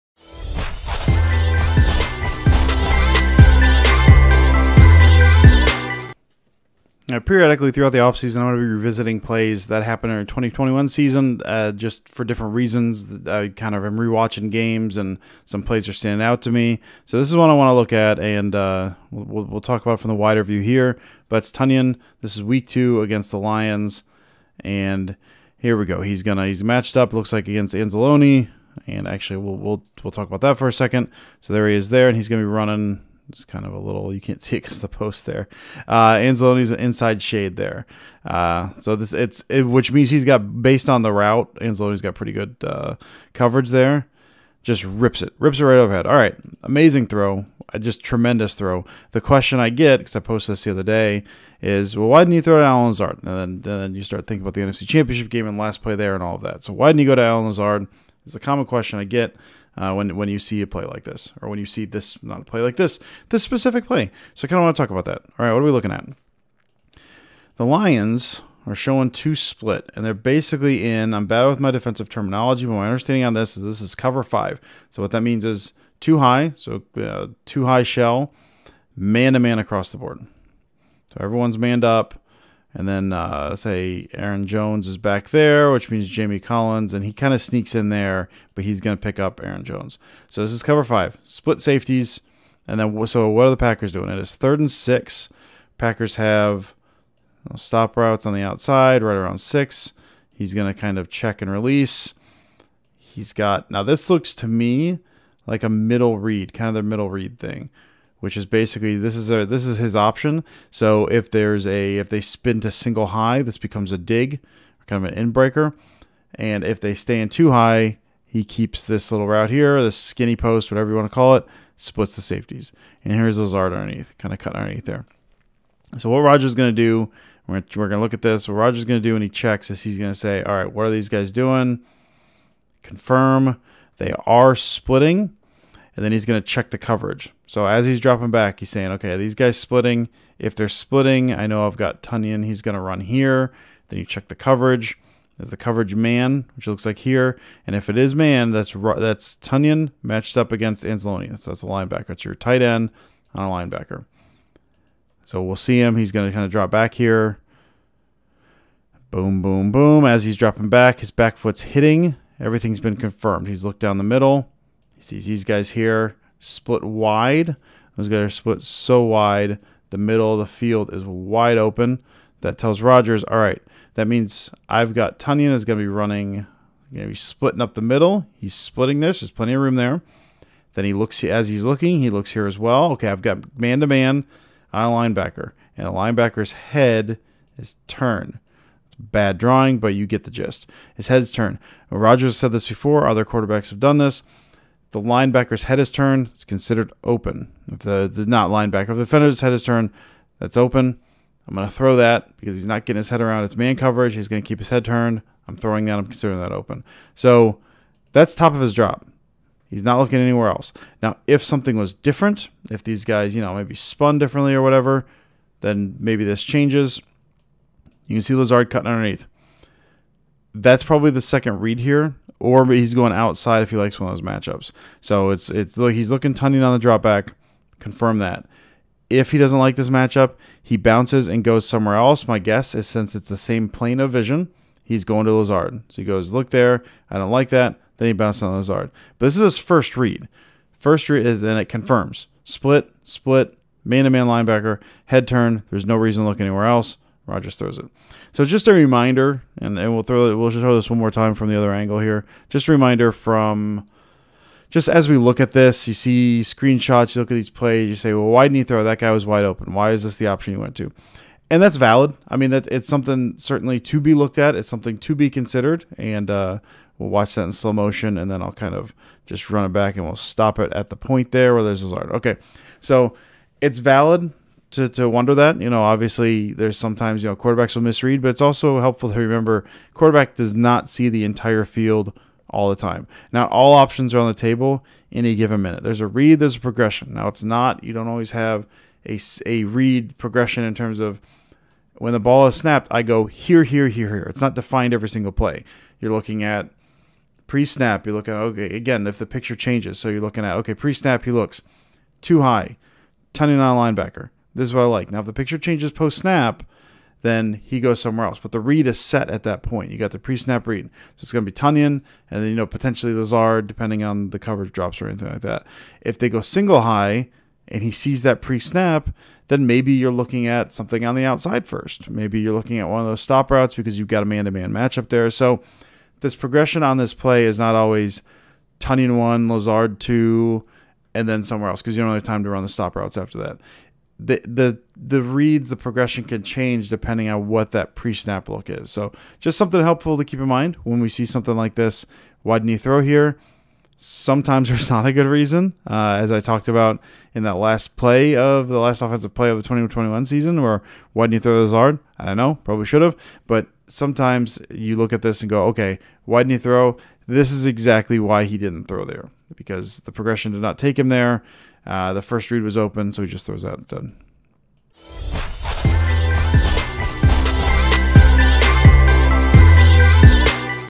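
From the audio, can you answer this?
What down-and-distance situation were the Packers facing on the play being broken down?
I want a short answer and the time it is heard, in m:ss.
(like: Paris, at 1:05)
Third and six, at 1:34.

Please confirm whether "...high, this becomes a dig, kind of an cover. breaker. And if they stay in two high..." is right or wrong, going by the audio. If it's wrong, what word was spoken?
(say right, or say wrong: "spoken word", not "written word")
wrong: "inbreaker", not "cover".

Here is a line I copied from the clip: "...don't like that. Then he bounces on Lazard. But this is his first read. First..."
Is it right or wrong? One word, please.
right.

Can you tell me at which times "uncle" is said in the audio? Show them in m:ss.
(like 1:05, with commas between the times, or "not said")
not said.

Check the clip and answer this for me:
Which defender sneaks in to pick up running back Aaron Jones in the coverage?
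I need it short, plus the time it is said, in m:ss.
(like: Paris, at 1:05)
Jamie Collins, at 1:26.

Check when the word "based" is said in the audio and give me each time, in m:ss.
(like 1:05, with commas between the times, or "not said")
0:40.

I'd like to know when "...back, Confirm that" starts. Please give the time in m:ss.
3:47.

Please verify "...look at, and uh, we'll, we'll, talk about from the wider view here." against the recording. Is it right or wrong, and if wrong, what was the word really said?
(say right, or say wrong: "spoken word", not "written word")
right.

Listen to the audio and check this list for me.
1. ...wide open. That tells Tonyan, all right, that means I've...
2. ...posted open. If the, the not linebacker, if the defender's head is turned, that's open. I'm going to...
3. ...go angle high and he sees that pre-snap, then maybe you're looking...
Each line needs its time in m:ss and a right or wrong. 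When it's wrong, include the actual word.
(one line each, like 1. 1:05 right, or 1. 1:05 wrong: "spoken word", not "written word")
1. 2:51 wrong: "Rodgers", not "Tonyan"
2. 3:16 wrong: "considered", not "posted"
3. 5:16 wrong: "single", not "angle".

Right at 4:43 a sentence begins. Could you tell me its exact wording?
Not all options are on the table in a given minute.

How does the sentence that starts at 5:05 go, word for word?
Now, if the picture changes post snap, then he goes somewhere else.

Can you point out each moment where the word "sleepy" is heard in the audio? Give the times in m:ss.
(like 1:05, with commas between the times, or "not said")
not said.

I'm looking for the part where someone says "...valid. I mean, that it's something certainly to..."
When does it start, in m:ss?
4:21.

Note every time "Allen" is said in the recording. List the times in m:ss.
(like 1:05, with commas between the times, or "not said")
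0:52, 0:57.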